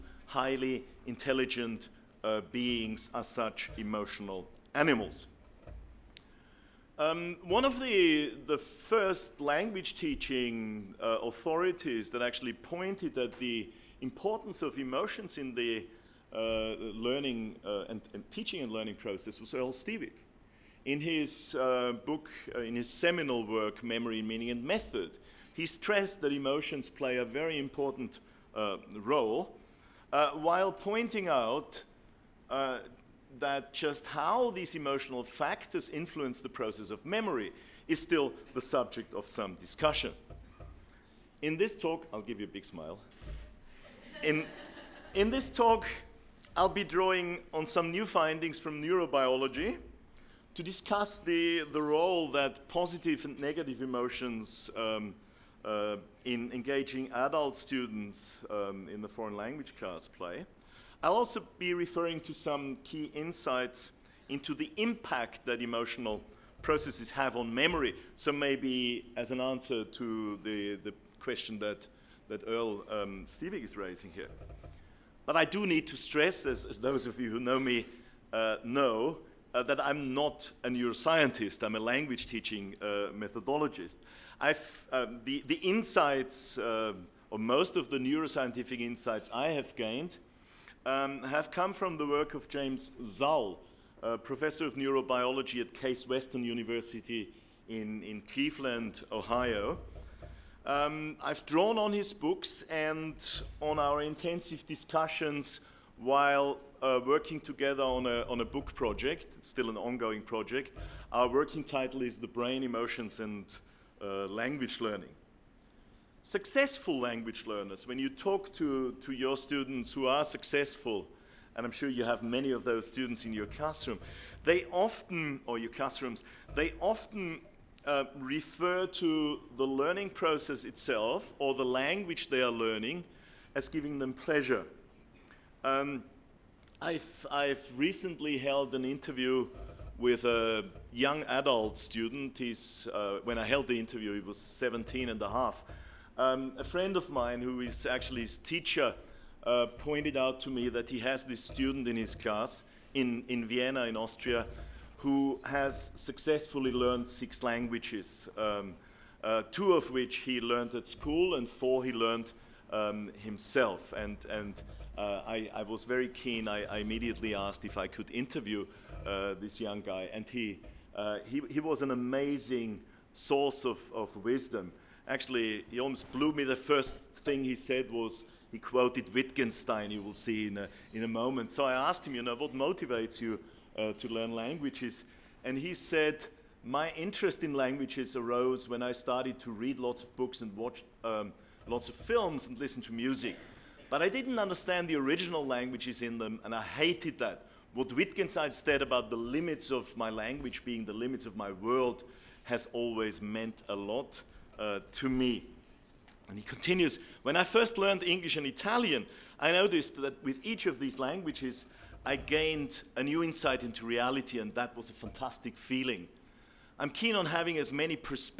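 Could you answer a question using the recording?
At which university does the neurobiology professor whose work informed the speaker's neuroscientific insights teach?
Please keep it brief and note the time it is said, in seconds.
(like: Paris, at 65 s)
Case Western University, at 95 s.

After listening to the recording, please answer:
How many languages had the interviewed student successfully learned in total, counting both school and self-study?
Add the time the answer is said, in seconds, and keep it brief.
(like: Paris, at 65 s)
6, at 157 s.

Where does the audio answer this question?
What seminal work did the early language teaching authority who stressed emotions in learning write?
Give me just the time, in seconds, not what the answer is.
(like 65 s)
23 s.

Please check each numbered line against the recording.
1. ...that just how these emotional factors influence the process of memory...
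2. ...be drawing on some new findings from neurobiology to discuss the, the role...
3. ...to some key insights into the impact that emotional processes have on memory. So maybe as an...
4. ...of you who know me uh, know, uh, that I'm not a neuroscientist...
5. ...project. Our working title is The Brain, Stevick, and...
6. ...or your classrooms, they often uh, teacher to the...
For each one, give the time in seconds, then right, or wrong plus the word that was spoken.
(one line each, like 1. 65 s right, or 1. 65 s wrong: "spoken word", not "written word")
1. 33 s right
2. 46 s right
3. 62 s right
4. 77 s right
5. 110 s wrong: "Emotions", not "Stevick"
6. 125 s wrong: "refer", not "teacher".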